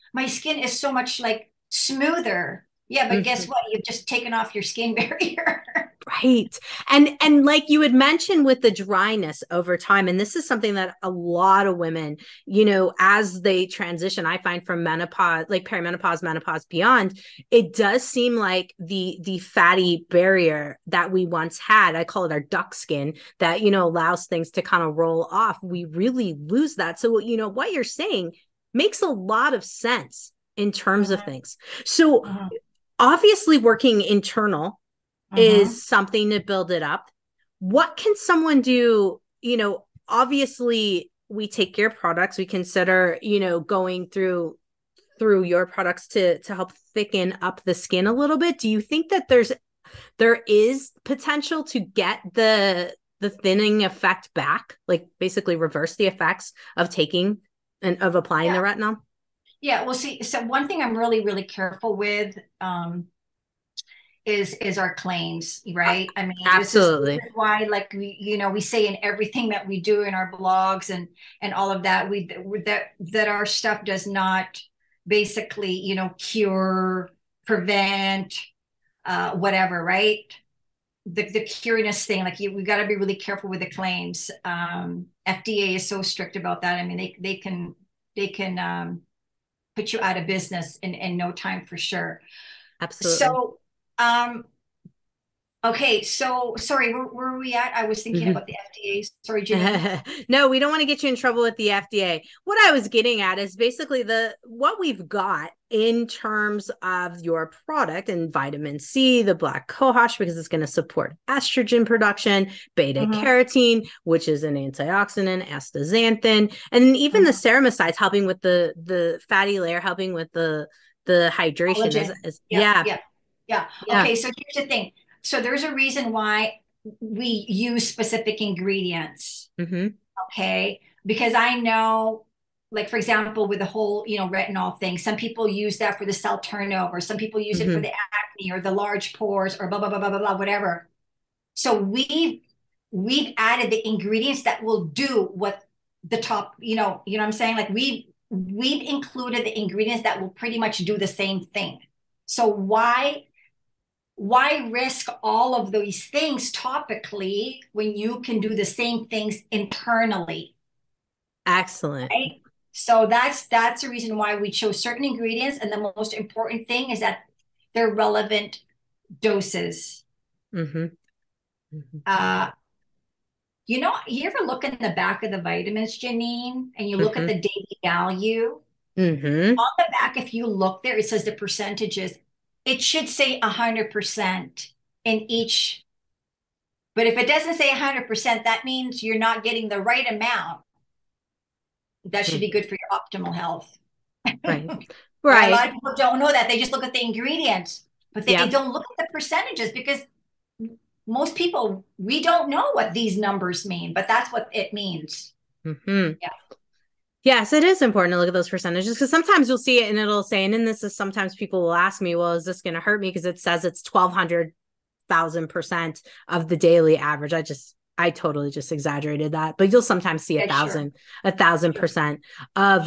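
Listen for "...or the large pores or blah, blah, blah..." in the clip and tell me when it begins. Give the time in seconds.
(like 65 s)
138 s.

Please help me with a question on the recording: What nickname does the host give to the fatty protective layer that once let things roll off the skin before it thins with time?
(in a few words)
duck skin.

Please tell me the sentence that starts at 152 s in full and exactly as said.
So why why risk all of these things topically when you can do the same things internally excellent right?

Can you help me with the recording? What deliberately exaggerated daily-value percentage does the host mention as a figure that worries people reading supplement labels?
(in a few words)
1200 thousand percent.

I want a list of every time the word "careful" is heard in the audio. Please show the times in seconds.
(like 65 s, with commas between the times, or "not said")
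61 s, 83 s.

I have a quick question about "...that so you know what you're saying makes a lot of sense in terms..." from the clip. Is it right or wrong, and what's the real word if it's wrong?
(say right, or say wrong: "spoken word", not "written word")
right.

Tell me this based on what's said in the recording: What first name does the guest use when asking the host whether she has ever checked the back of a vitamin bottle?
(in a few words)
Jannine.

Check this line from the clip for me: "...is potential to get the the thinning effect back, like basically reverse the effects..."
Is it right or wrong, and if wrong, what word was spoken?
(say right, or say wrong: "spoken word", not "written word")
right.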